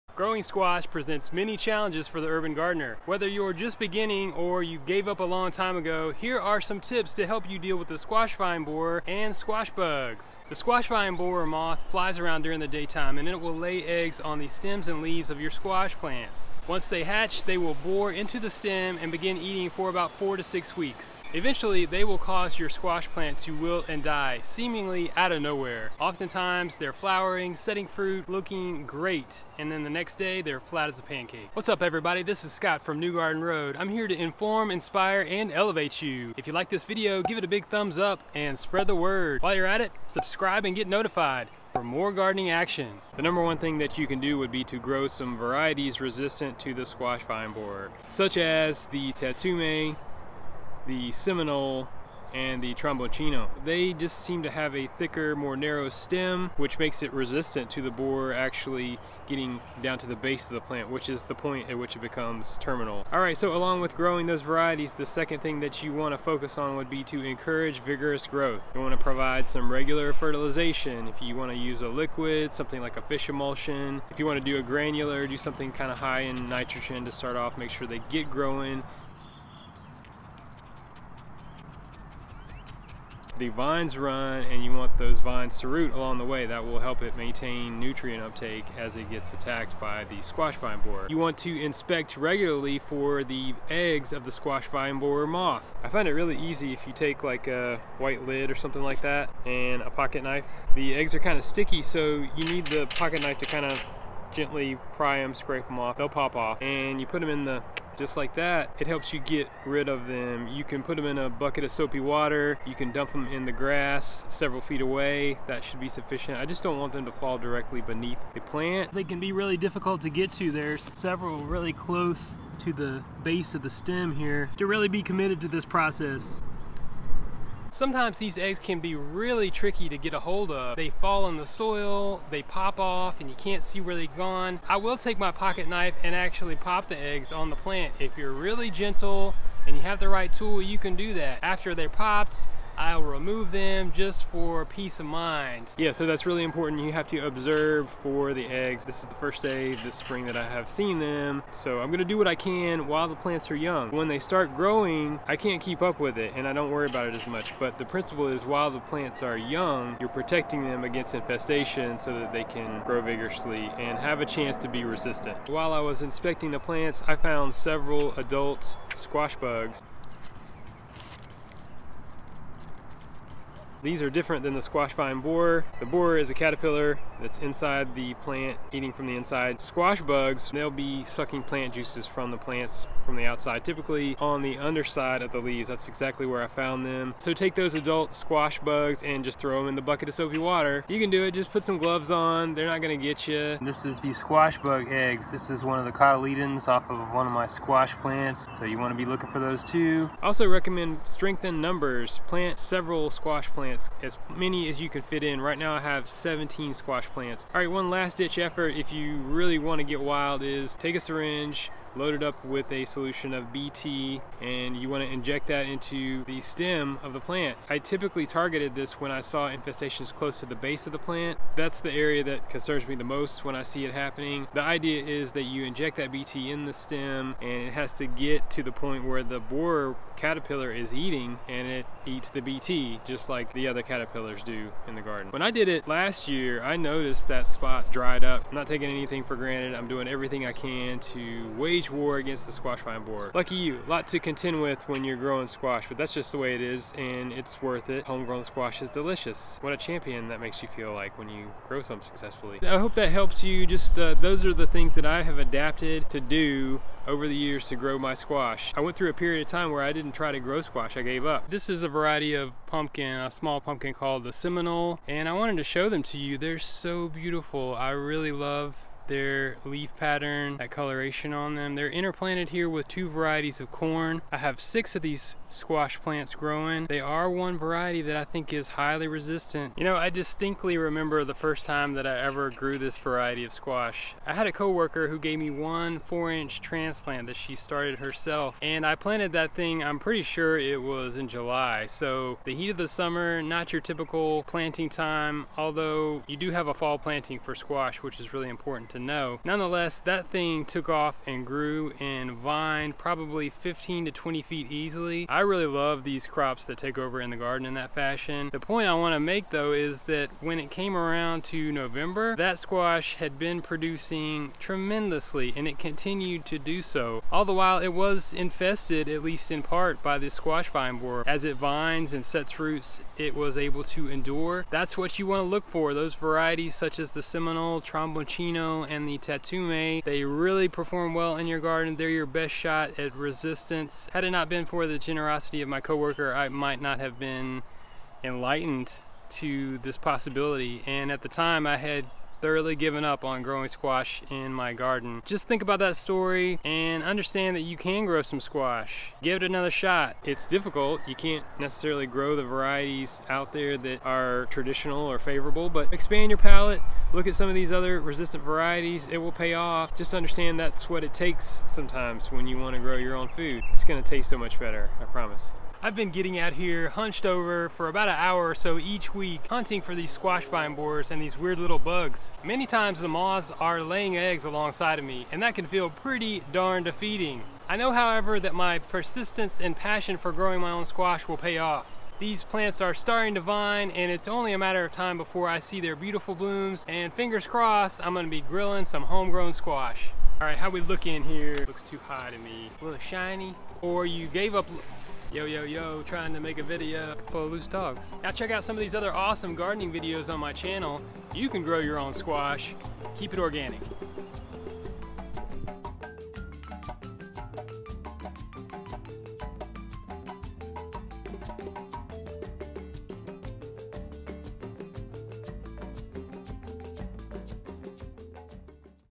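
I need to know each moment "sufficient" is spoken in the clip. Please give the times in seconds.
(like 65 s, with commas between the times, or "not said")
115 s.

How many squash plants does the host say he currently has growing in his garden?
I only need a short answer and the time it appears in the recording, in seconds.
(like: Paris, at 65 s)
17, at 206 s.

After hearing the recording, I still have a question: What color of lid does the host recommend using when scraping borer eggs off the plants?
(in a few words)
White.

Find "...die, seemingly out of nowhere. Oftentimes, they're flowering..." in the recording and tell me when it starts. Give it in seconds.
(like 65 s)
24 s.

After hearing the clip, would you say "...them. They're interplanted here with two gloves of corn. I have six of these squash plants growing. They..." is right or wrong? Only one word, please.
wrong.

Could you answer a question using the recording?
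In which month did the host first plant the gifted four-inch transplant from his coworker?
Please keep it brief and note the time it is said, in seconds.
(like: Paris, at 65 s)
July, at 291 s.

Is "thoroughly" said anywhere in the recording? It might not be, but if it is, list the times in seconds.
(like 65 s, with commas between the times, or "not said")
342 s.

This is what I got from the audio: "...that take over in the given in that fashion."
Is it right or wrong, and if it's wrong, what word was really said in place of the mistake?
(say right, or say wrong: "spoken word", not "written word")
wrong: "garden", not "given".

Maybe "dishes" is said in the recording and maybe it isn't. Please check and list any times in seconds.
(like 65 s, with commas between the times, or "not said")
not said.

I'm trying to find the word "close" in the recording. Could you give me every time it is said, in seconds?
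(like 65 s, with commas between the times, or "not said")
121 s, 220 s.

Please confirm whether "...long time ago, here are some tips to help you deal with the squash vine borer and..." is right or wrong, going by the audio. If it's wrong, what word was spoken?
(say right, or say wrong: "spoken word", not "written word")
right.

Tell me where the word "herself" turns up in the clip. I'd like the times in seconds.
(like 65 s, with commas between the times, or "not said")
287 s.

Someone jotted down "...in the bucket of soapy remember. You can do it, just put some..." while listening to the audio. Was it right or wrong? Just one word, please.
wrong.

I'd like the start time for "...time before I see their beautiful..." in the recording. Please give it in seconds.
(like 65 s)
384 s.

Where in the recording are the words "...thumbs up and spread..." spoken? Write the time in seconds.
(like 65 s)
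37 s.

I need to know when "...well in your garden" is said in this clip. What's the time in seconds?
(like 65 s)
331 s.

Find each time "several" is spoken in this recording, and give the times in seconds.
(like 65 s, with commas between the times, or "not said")
114 s, 120 s, 167 s, 202 s.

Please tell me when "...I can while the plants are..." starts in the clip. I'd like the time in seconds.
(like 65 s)
152 s.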